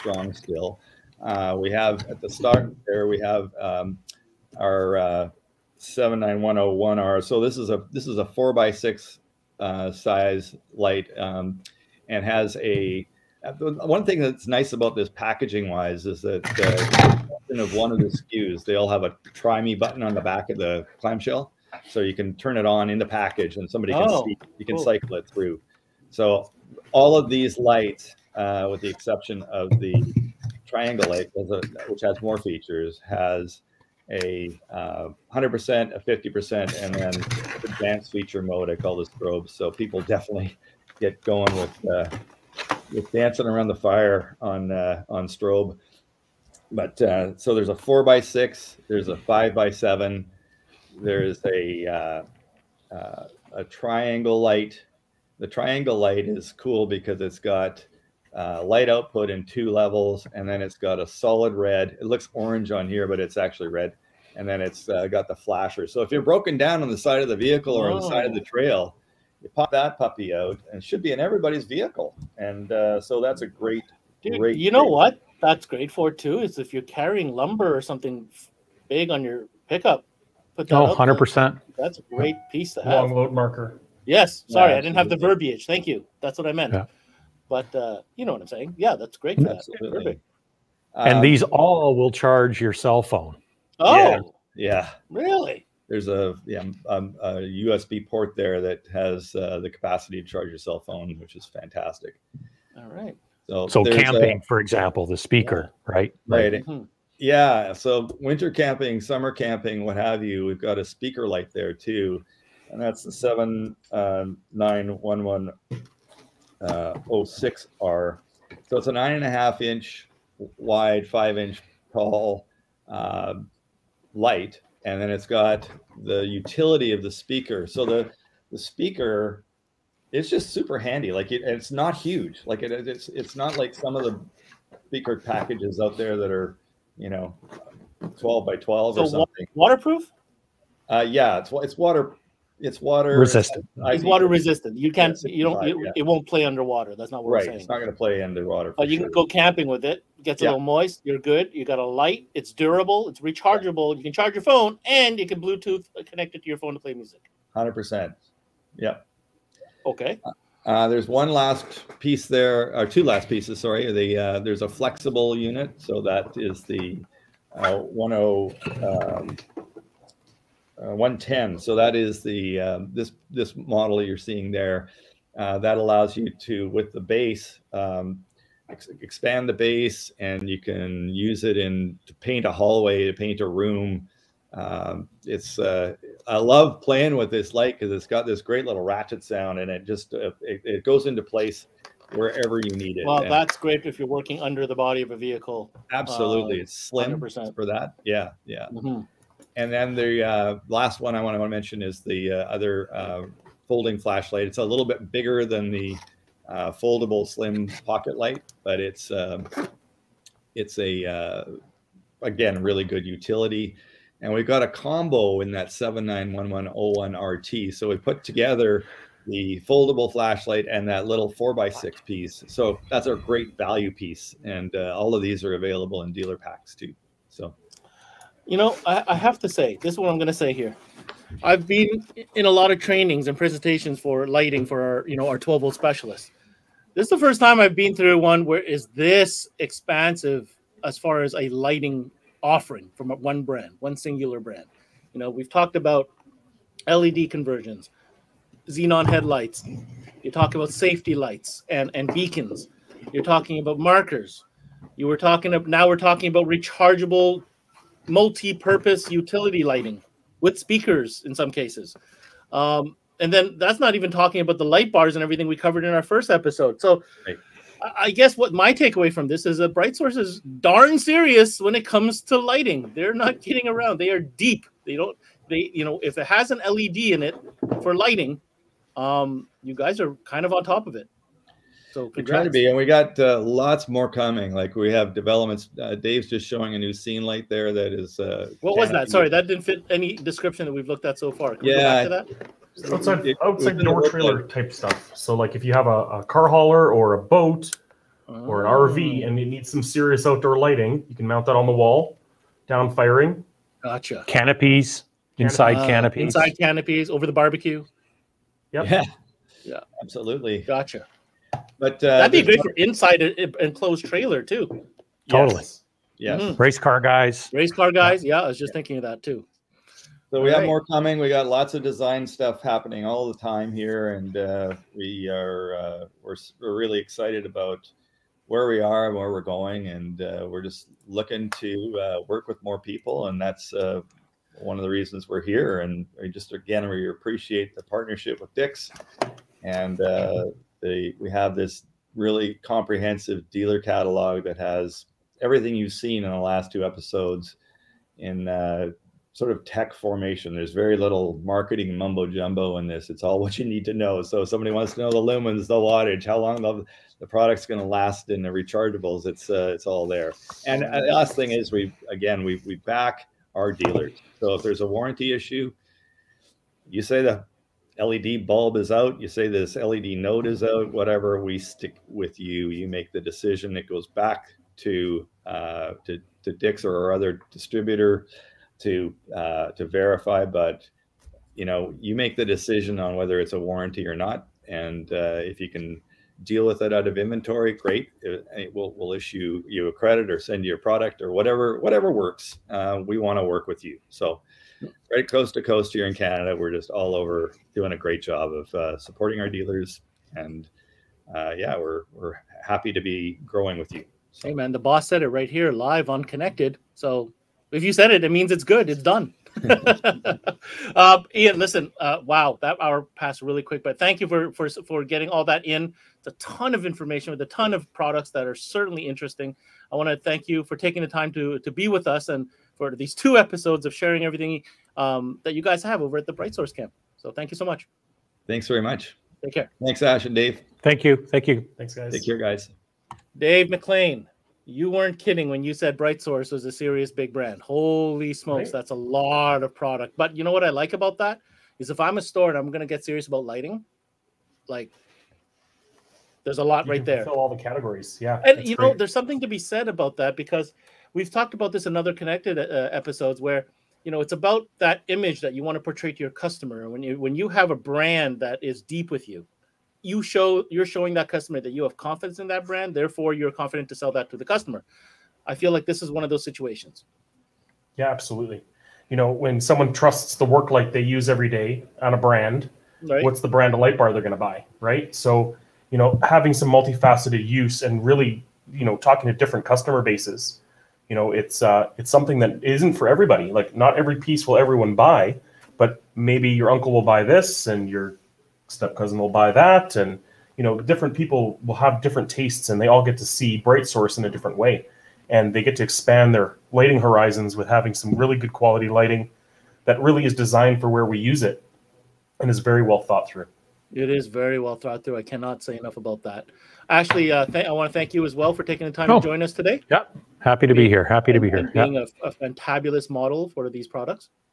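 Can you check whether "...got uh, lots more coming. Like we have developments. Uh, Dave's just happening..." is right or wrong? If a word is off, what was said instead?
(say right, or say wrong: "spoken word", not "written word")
wrong: "showing", not "happening".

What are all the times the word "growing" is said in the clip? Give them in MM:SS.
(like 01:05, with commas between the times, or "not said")
06:43.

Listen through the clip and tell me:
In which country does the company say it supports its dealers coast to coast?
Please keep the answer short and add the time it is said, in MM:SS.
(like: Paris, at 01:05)
Canada, at 06:36.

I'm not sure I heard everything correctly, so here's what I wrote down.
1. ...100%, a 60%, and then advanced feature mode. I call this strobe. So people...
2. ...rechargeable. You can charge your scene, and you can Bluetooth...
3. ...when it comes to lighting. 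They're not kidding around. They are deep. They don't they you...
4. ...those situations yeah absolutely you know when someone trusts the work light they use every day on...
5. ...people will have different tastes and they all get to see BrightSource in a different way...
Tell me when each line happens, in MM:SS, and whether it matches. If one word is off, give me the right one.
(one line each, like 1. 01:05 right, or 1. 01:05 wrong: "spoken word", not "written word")
1. 00:35 wrong: "50", not "60"
2. 02:33 wrong: "phone", not "scene"
3. 04:31 right
4. 07:46 right
5. 08:11 right.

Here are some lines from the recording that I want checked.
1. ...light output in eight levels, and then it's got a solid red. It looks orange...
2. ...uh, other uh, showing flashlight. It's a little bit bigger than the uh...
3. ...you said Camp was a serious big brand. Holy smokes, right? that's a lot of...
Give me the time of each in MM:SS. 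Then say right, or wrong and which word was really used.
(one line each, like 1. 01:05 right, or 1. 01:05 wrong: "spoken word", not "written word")
1. 00:58 wrong: "two", not "eight"
2. 03:22 wrong: "folding", not "showing"
3. 07:15 wrong: "BrightSource", not "Camp".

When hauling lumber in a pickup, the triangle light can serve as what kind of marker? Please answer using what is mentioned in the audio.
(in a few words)
Long load marker.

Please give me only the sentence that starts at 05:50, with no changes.
There's very little marketing mumbo jumbo in this.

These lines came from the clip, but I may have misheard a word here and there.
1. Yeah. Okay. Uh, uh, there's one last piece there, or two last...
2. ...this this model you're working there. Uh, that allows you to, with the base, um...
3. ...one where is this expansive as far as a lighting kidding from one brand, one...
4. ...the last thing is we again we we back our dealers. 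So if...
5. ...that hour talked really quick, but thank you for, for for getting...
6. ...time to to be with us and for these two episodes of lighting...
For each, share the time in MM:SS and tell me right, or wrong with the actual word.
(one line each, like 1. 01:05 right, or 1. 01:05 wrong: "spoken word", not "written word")
1. 02:38 right
2. 02:52 wrong: "seeing", not "working"
3. 03:58 wrong: "offering", not "kidding"
4. 06:01 right
5. 06:52 wrong: "passed", not "talked"
6. 07:01 wrong: "sharing", not "lighting".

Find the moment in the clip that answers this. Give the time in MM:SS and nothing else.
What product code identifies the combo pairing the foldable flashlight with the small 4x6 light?
03:35.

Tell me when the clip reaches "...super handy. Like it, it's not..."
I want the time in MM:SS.
02:10.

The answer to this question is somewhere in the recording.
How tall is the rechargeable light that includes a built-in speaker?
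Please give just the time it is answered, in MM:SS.
02:01.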